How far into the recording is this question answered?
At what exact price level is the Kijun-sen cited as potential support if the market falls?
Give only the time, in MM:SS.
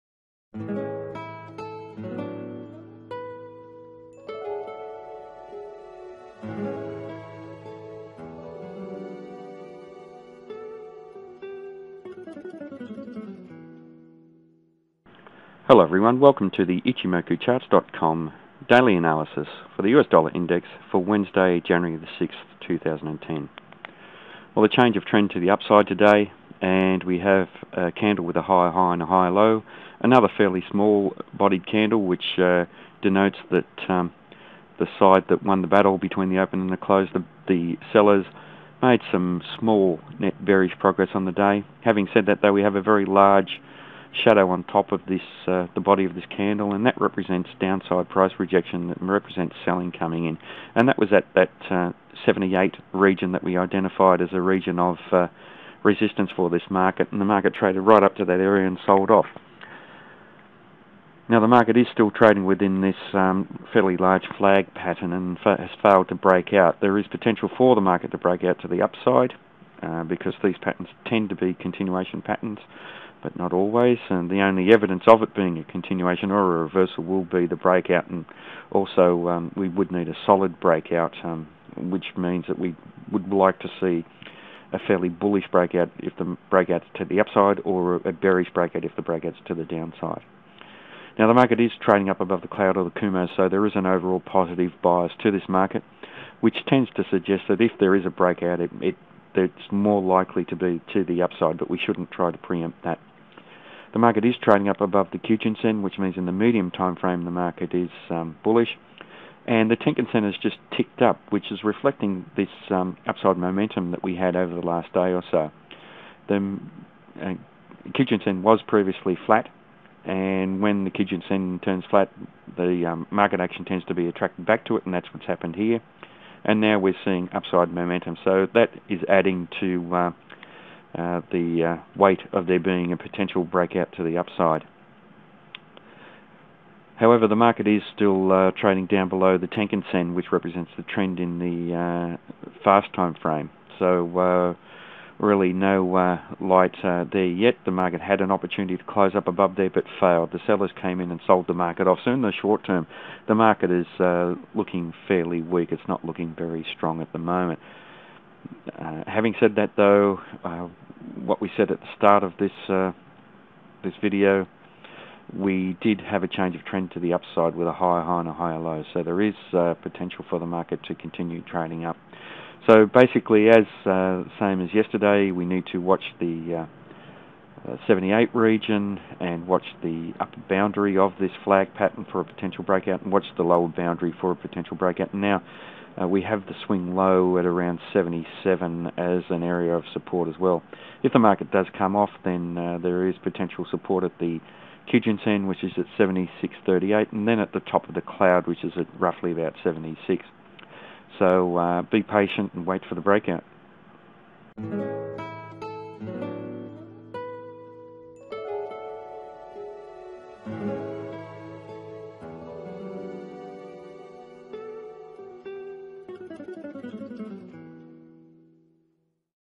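03:15.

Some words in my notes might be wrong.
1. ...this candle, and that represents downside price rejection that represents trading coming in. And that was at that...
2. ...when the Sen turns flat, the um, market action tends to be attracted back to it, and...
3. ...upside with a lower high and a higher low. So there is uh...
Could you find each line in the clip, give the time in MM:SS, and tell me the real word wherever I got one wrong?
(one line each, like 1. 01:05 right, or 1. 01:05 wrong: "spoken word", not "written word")
1. 00:46 wrong: "selling", not "trading"
2. 02:00 right
3. 02:47 wrong: "higher", not "lower".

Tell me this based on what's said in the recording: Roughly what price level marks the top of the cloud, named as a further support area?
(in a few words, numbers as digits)
About 76.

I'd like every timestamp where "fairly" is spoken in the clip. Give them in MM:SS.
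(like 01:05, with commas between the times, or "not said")
00:30, 01:03, 01:24, 02:35.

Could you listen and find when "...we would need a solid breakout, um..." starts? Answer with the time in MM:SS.
01:19.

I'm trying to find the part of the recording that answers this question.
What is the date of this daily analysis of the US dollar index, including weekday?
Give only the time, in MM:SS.
00:21.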